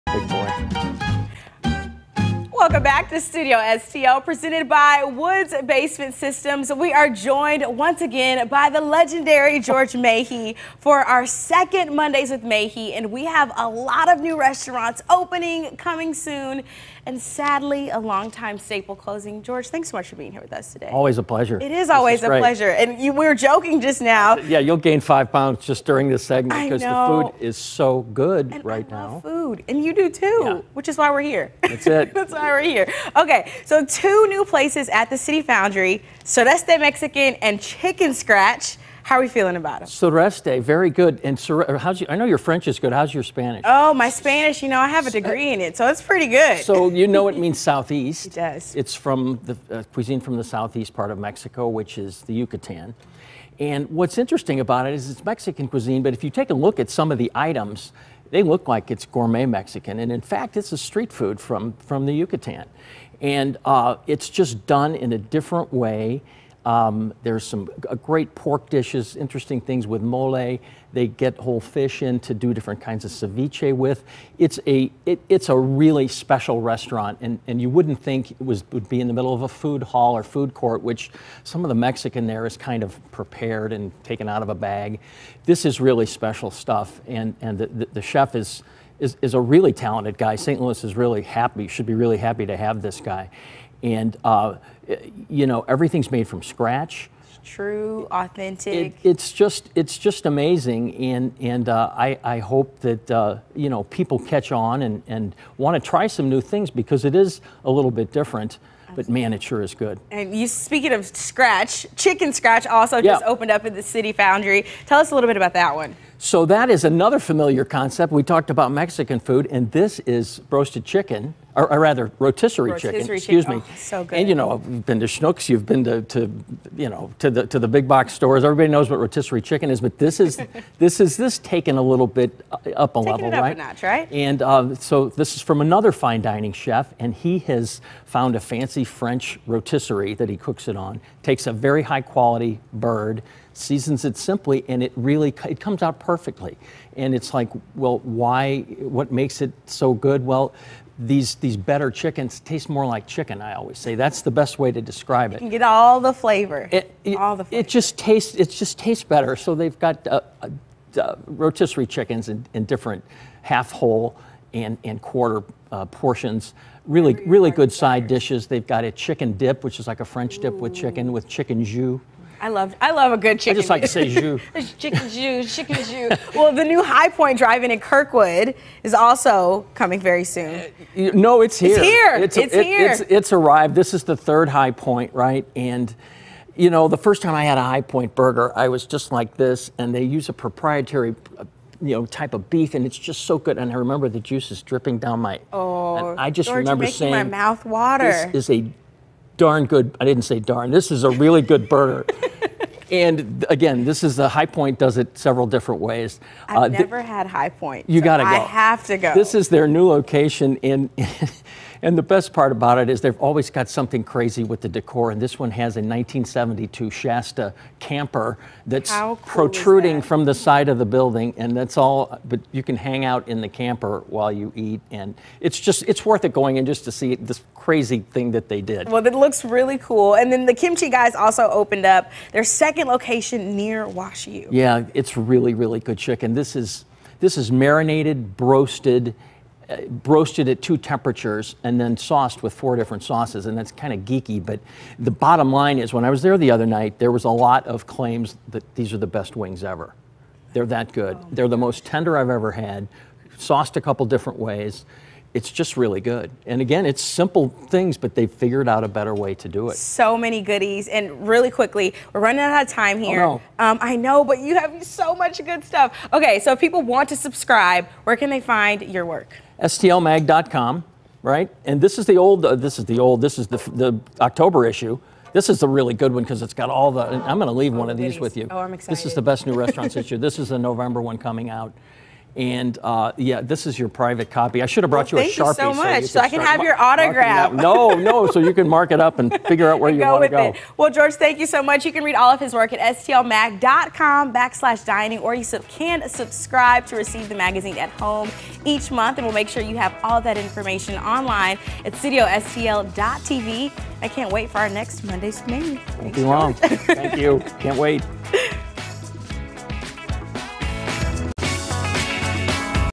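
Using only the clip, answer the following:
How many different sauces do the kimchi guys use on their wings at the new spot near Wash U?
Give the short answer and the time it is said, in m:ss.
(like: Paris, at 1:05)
4, at 4:02.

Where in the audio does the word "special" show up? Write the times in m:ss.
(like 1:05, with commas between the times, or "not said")
1:16, 1:26.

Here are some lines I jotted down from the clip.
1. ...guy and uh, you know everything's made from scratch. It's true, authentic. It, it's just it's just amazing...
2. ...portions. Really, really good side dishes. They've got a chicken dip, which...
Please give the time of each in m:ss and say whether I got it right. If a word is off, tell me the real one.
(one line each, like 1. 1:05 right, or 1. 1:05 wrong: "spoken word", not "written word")
1. 1:33 right
2. 2:45 right.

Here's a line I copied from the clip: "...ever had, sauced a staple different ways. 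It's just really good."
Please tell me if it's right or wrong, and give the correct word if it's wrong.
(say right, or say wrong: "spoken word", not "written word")
wrong: "couple", not "staple".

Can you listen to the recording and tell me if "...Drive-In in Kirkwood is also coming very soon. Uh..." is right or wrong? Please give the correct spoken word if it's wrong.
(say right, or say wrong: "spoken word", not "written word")
right.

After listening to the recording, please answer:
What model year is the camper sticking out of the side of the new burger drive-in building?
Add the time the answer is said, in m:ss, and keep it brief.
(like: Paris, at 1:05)
1972, at 3:35.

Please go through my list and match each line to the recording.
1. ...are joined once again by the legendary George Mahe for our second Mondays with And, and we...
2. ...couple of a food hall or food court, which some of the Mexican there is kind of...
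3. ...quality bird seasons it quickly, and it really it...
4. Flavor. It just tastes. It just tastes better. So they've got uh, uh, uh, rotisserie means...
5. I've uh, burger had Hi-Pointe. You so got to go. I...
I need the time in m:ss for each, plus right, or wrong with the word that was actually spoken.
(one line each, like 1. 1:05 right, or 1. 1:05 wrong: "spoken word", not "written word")
1. 0:06 wrong: "Mahe", not "And"
2. 1:19 wrong: "middle", not "couple"
3. 2:22 wrong: "simply", not "quickly"
4. 2:37 wrong: "chickens", not "means"
5. 3:26 wrong: "never", not "burger".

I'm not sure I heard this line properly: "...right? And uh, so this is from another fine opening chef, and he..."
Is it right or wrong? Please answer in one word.
wrong.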